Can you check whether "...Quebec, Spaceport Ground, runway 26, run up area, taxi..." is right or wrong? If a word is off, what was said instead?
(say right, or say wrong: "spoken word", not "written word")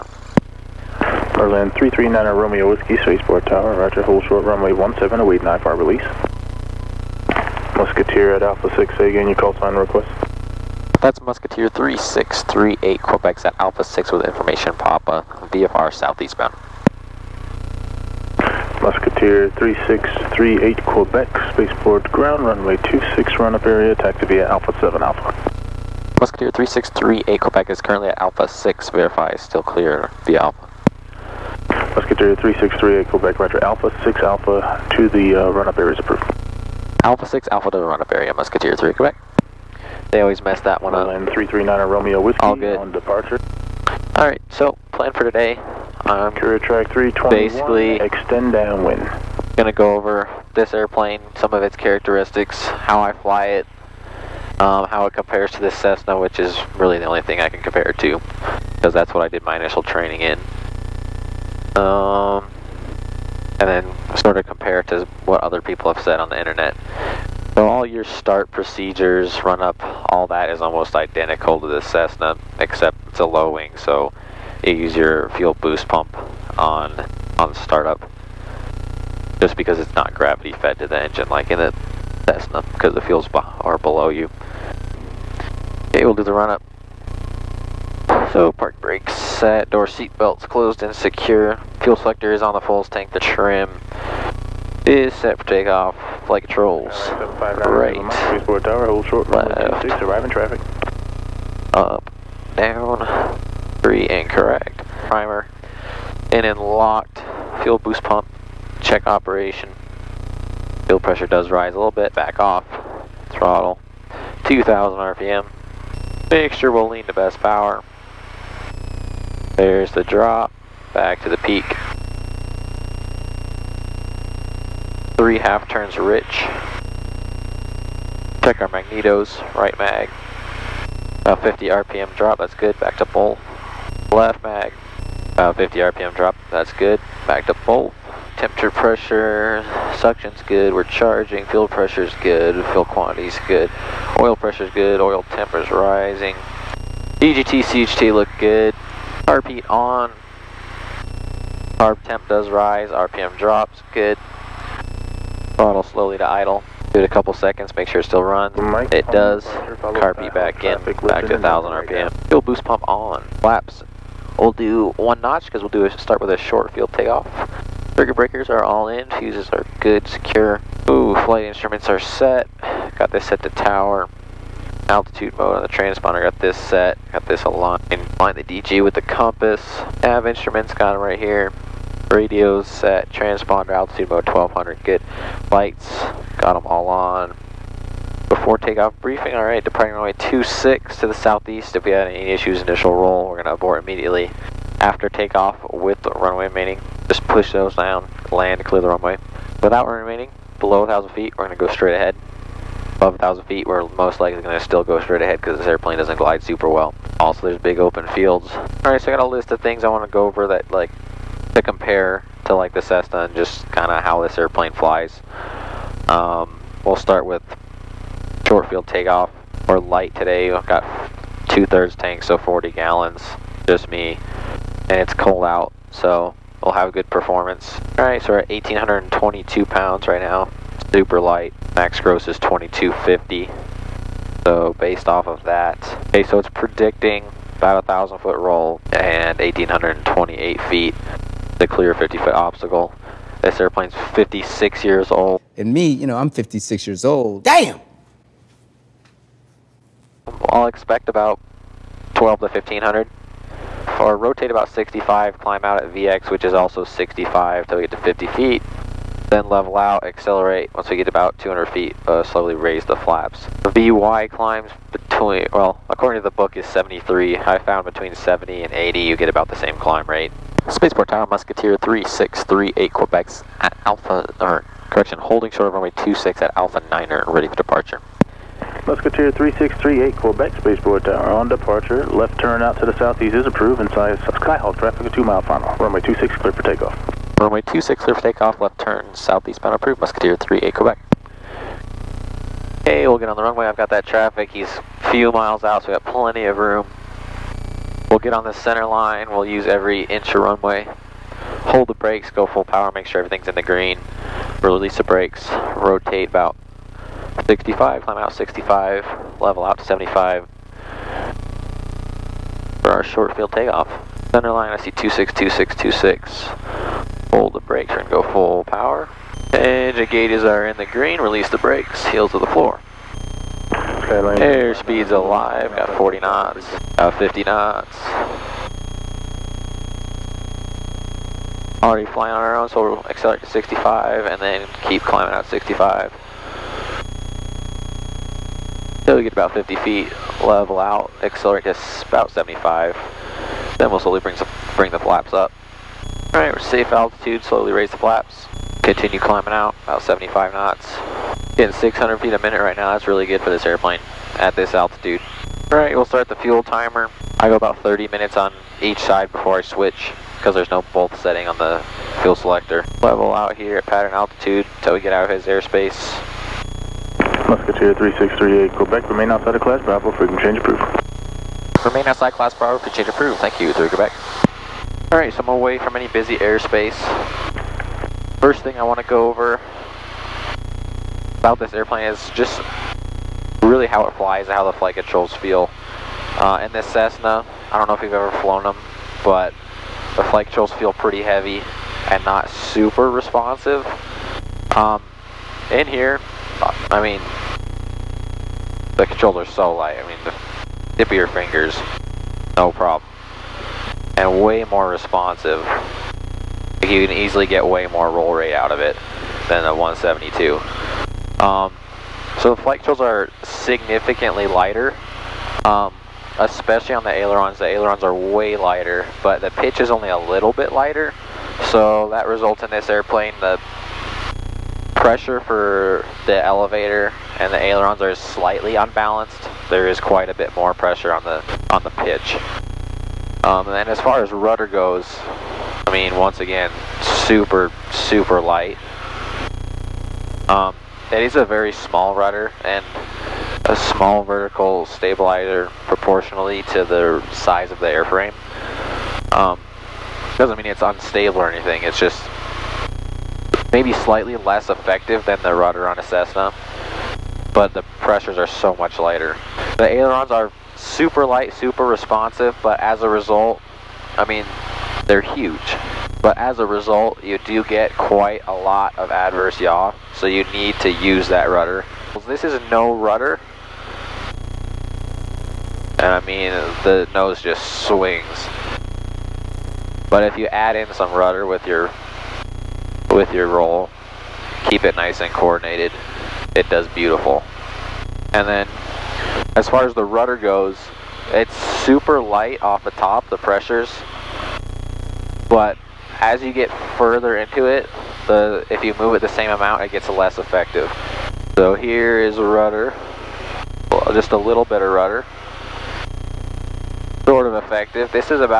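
right.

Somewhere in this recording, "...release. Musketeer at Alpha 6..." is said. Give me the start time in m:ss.
0:05.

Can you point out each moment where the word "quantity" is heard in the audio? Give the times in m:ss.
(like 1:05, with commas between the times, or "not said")
2:22.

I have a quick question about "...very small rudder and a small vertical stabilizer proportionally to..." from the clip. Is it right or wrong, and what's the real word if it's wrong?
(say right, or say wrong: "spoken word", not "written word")
right.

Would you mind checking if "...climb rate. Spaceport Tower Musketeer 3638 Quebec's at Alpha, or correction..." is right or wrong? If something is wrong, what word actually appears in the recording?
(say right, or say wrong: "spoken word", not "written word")
right.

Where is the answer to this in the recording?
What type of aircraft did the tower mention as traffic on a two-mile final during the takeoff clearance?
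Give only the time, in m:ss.
4:44.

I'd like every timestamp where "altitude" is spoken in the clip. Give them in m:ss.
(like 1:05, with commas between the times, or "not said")
2:54, 3:03, 5:46, 5:54, 6:04.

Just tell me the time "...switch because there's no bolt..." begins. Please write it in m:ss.
5:59.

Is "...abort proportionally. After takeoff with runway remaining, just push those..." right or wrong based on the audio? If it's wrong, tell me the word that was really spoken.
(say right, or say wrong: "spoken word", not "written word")
wrong: "immediately", not "proportionally".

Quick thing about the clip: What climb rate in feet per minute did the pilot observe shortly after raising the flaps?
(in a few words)
600 feet a minute.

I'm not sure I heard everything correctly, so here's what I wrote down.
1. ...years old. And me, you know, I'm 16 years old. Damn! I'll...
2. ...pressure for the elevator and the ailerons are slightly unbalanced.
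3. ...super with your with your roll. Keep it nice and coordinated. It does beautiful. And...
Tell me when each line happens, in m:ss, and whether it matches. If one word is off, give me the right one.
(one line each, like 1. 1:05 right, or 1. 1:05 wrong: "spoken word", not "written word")
1. 4:04 wrong: "56", not "16"
2. 7:04 right
3. 8:01 wrong: "rudder", not "super".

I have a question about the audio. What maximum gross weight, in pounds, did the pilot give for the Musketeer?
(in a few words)
2250.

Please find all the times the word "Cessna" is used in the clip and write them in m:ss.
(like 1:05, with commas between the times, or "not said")
0:55, 1:11, 1:22, 3:32, 6:26, 7:36.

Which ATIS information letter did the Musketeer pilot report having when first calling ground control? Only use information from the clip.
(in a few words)
Papa.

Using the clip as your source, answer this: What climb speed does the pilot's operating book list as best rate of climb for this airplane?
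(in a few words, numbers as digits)
73.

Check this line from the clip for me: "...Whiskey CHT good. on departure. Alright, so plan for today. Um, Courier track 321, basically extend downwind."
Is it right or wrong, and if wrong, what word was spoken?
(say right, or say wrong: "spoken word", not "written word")
wrong: "All", not "CHT".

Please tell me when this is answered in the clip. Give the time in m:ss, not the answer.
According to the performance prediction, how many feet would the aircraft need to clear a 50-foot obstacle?
3:59.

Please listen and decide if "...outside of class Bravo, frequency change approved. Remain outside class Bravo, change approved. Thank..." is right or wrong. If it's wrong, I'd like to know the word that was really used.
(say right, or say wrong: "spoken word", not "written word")
right.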